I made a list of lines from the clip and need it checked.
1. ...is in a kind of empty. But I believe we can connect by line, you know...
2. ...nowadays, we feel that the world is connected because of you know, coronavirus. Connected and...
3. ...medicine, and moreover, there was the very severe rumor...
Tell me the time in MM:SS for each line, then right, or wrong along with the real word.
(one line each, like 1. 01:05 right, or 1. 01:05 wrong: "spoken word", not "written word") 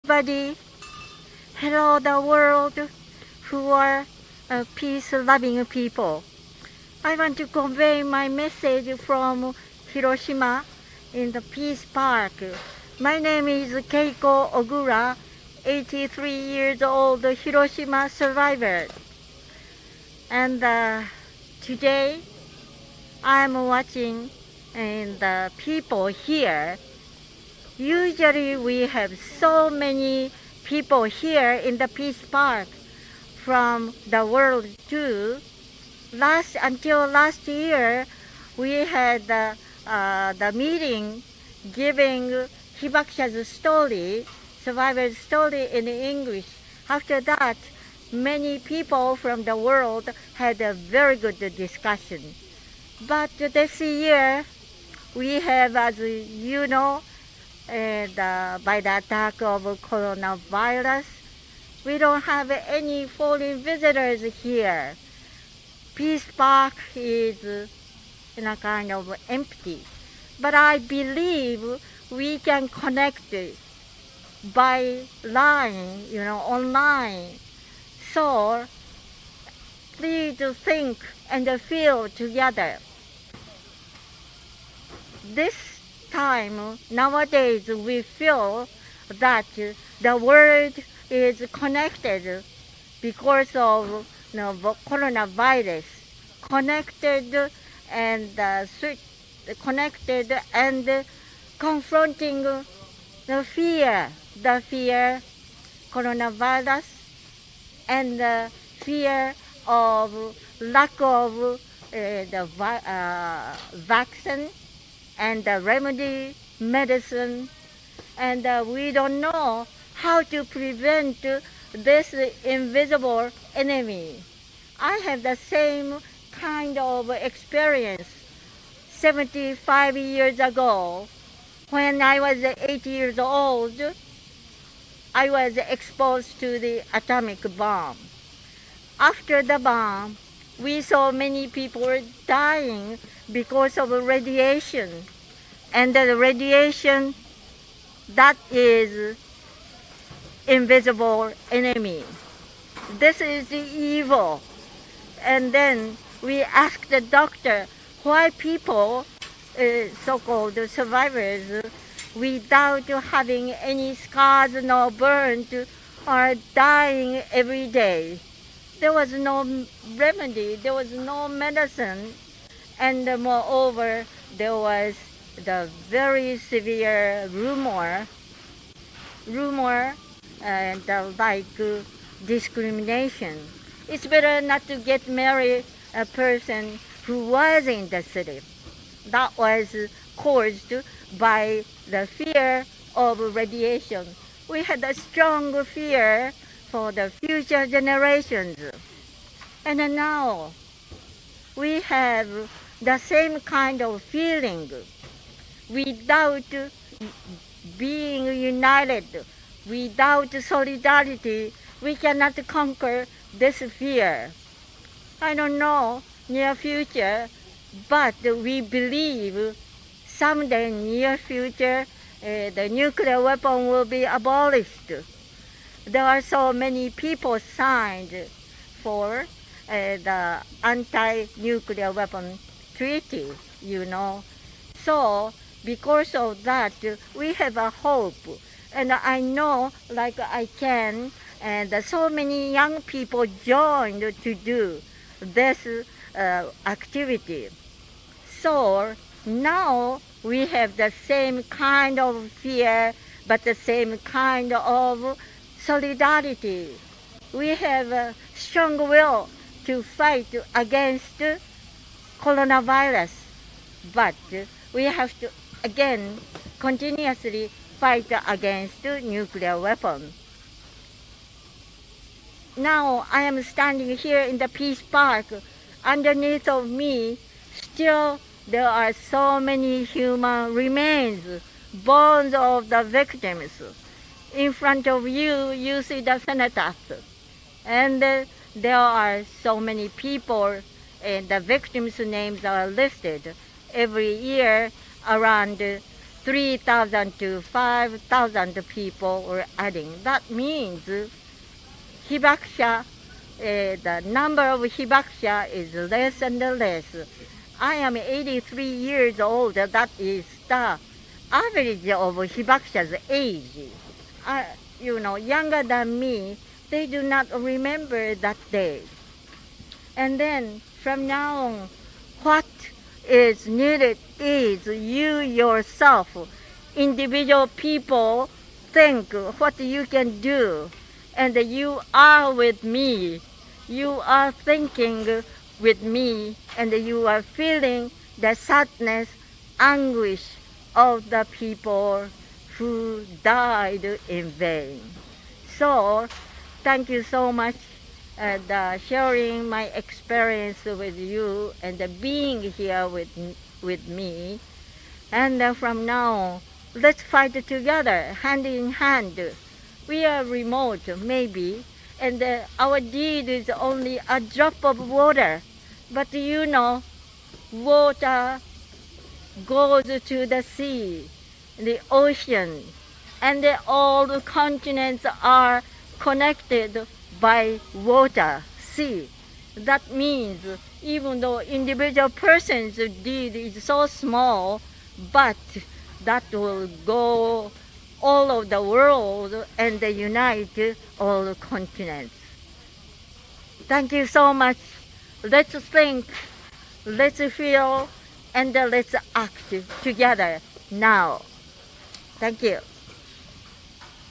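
1. 01:06 right
2. 01:26 right
3. 02:51 right.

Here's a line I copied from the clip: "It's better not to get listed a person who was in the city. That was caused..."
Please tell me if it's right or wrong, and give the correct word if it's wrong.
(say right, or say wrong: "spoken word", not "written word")
wrong: "married", not "listed".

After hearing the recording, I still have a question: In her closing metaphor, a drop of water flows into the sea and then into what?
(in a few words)
the ocean.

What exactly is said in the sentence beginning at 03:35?
I don't know near future, but we believe someday near future uh, the nuclear weapon will be abolished.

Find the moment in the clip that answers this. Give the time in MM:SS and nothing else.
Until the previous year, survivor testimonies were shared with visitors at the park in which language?
00:45.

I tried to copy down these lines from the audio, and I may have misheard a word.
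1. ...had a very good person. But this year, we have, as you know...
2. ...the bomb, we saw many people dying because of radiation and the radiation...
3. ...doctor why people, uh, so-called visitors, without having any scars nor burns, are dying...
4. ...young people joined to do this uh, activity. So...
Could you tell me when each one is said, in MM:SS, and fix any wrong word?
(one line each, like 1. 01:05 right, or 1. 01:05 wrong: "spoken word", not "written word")
1. 00:50 wrong: "discussion", not "person"
2. 02:19 right
3. 02:36 wrong: "survivors", not "visitors"
4. 04:02 right.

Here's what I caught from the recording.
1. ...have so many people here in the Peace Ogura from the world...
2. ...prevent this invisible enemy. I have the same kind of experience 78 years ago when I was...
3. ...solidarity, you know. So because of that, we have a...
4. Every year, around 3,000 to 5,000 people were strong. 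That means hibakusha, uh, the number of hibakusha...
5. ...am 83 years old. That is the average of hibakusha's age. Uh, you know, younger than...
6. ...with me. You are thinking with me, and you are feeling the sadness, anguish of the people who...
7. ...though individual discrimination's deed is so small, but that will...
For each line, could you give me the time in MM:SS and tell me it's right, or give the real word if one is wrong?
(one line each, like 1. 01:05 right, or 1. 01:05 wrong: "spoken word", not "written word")
1. 00:28 wrong: "Park", not "Ogura"
2. 02:00 wrong: "75", not "78"
3. 03:52 wrong: "treaty", not "solidarity"
4. 04:53 wrong: "adding", not "strong"
5. 05:07 right
6. 05:32 right
7. 06:21 wrong: "person", not "discrimination".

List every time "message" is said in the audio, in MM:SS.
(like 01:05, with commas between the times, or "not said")
00:08.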